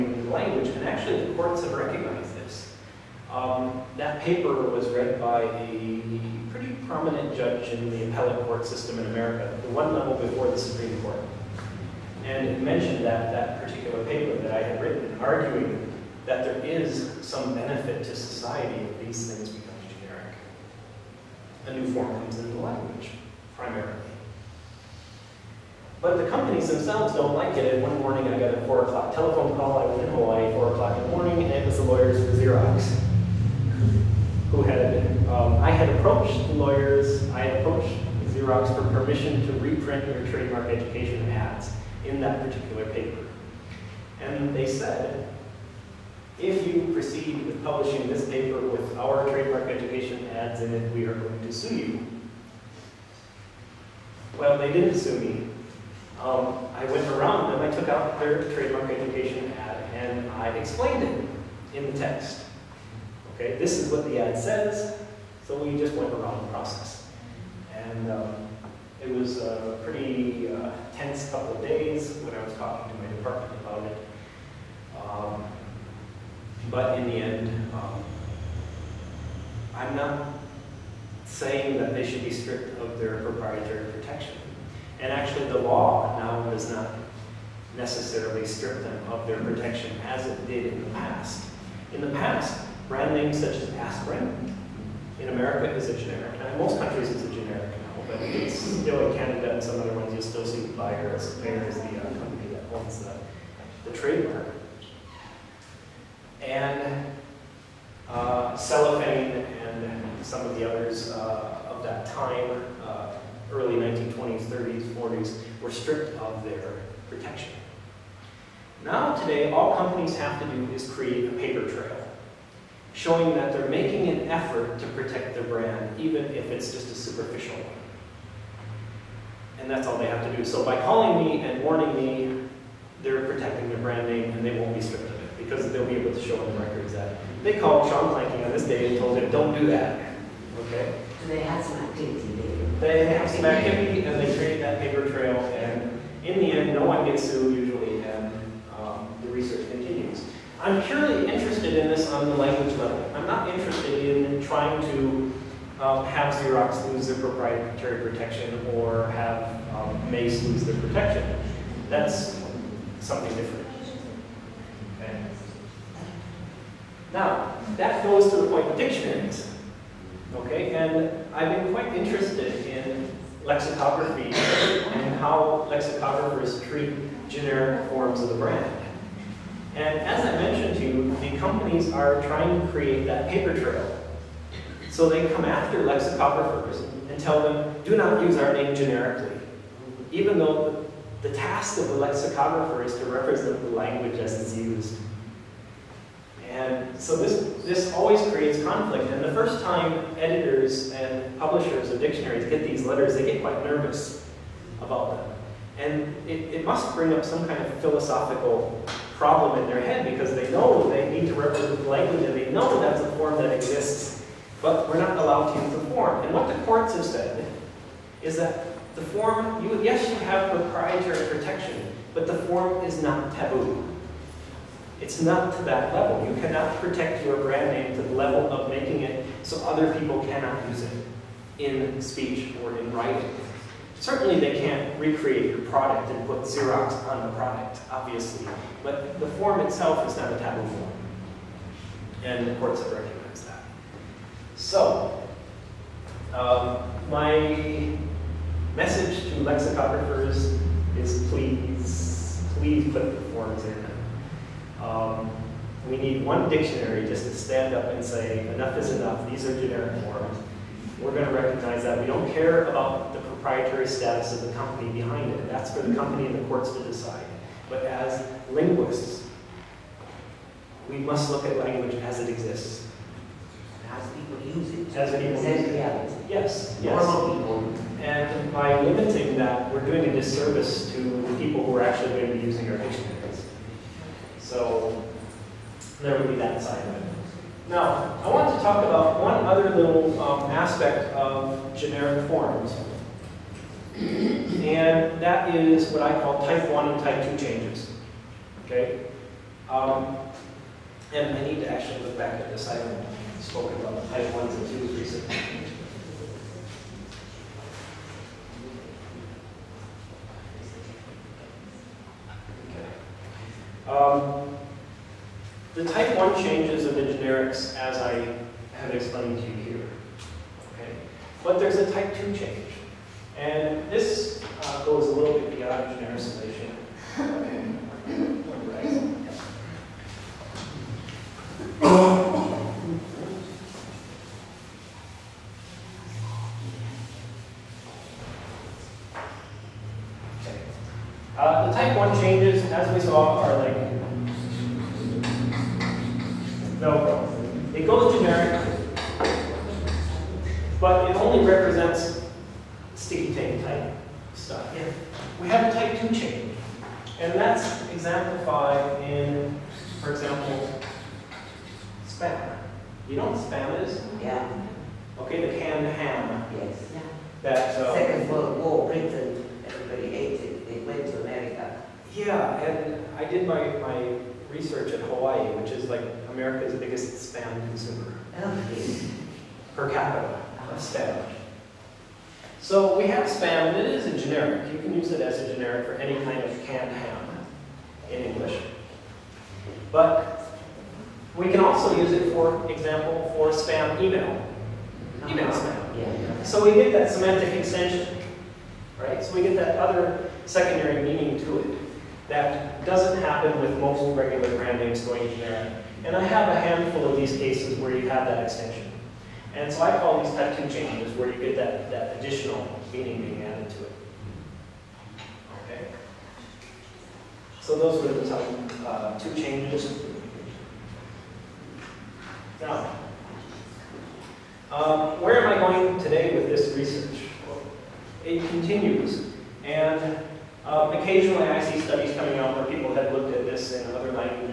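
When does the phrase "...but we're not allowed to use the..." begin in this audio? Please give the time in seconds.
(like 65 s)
214 s.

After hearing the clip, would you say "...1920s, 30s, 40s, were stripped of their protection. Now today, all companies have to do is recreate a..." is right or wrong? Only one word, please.
wrong.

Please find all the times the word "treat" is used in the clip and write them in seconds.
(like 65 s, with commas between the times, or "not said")
176 s.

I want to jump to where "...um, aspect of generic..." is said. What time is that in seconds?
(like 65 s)
290 s.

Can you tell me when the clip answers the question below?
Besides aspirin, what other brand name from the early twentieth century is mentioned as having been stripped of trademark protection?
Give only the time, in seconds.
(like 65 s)
108 s.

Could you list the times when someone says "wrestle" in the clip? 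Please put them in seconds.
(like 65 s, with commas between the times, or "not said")
not said.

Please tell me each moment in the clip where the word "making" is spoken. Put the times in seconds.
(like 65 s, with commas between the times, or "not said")
123 s, 228 s.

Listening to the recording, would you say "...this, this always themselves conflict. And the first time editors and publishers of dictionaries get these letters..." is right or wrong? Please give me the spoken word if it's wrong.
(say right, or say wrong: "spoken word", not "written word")
wrong: "creates", not "themselves".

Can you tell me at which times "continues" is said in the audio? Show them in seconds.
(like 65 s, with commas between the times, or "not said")
149 s, 428 s.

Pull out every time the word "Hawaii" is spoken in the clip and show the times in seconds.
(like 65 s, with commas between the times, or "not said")
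30 s, 375 s.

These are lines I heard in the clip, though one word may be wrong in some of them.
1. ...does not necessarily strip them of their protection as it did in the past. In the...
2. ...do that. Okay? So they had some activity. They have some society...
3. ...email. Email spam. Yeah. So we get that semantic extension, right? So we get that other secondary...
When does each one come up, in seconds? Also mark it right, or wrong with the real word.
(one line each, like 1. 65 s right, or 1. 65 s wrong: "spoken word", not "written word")
1. 86 s right
2. 139 s wrong: "activity", not "society"
3. 394 s right.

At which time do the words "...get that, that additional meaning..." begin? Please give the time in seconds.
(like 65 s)
411 s.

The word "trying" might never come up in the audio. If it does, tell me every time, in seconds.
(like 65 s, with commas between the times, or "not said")
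154 s, 182 s.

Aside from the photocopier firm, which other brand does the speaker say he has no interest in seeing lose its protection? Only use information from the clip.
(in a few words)
Mace.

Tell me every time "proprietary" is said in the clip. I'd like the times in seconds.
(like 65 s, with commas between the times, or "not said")
83 s, 157 s, 220 s, 263 s.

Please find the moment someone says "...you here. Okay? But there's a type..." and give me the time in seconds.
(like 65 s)
319 s.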